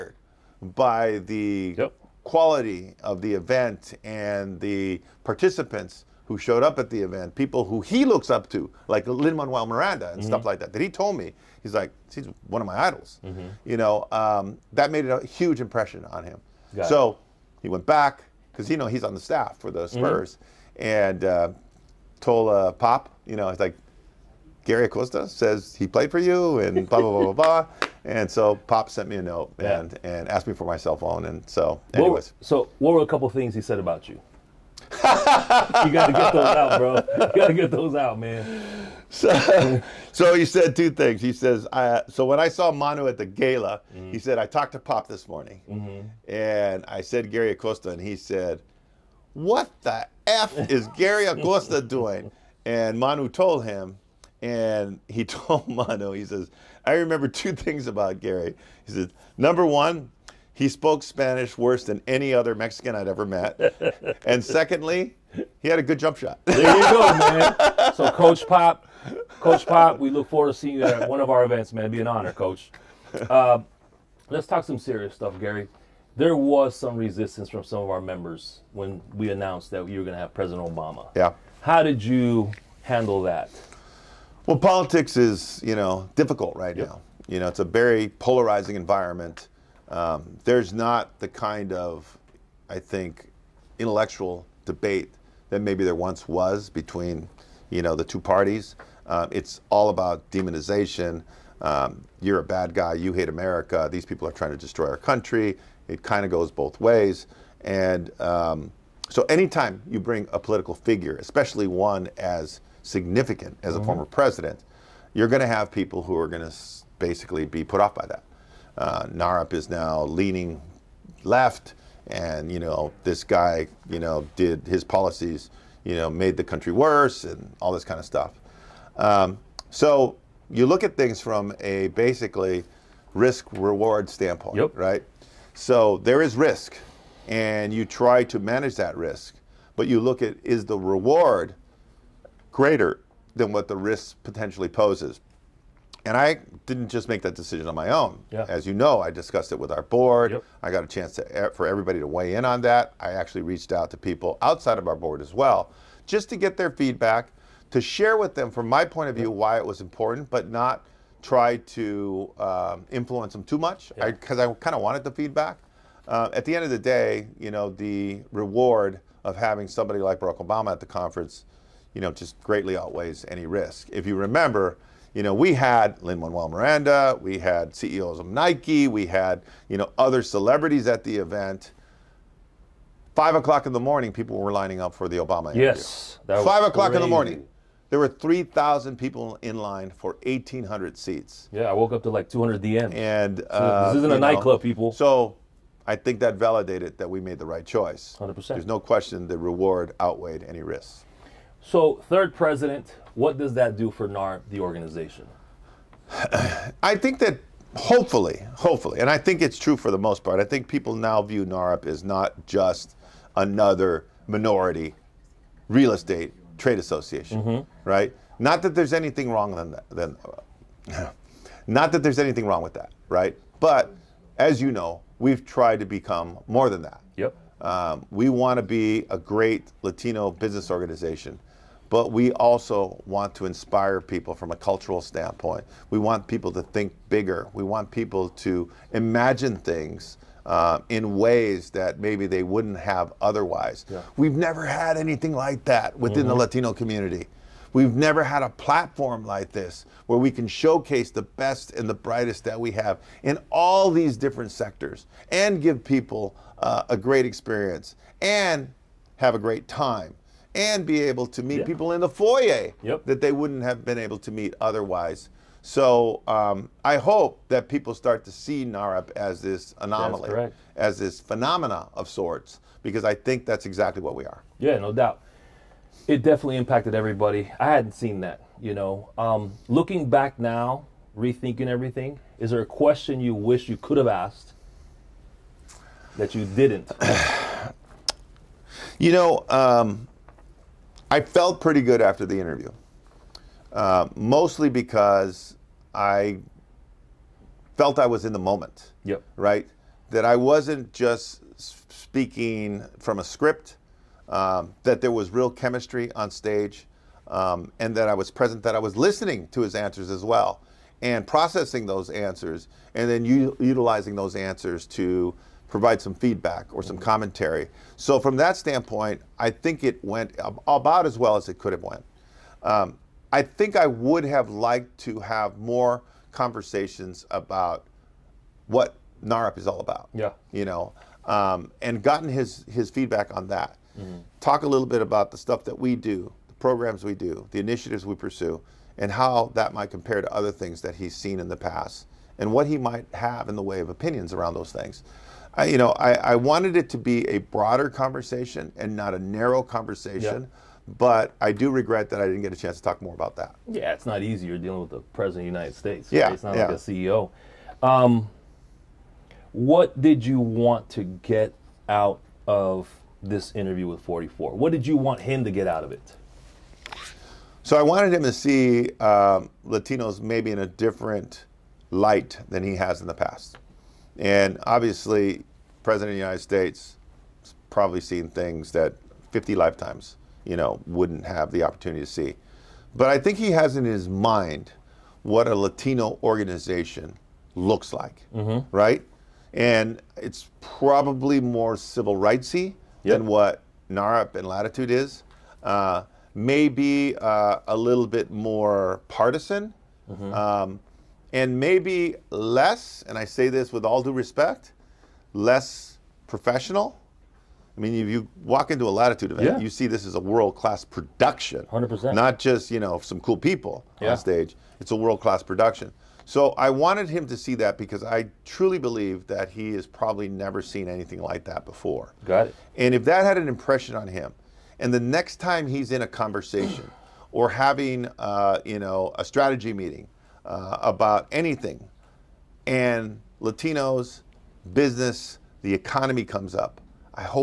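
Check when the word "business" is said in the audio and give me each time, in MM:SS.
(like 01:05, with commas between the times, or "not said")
03:50, 07:14.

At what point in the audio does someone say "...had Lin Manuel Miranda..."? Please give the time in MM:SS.
02:55.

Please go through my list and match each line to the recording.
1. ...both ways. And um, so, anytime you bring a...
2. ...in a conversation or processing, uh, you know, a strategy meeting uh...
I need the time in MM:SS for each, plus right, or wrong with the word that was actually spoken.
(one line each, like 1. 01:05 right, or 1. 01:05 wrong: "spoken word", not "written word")
1. 01:46 right
2. 07:05 wrong: "having", not "processing".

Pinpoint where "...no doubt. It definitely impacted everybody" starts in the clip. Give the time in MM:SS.
04:34.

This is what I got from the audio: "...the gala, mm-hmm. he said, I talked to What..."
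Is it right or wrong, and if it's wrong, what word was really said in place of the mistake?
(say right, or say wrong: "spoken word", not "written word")
wrong: "Pop", not "What".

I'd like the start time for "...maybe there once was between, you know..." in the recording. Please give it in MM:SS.
01:35.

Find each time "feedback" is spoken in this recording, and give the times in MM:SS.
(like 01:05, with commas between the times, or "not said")
02:36, 02:45, 05:16, 05:32.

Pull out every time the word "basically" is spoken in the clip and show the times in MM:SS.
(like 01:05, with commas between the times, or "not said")
01:56, 02:11.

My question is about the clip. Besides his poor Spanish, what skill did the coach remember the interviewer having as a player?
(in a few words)
jump shot.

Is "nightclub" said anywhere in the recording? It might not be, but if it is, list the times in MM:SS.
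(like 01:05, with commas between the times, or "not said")
03:14.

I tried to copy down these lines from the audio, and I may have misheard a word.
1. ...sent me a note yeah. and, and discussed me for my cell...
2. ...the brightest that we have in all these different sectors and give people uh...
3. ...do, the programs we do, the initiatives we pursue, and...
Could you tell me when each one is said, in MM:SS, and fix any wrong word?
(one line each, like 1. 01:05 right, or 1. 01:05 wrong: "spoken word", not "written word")
1. 00:28 wrong: "asked", not "discussed"
2. 04:11 right
3. 05:35 right.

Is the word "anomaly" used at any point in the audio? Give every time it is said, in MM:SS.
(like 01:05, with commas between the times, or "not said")
04:29.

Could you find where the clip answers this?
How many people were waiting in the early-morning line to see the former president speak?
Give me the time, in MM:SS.
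03:08.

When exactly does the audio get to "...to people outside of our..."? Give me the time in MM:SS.
02:33.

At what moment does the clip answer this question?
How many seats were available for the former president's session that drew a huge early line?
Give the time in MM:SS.
03:10.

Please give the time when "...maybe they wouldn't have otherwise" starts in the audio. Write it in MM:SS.
04:02.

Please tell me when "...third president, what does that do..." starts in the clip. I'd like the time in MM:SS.
03:22.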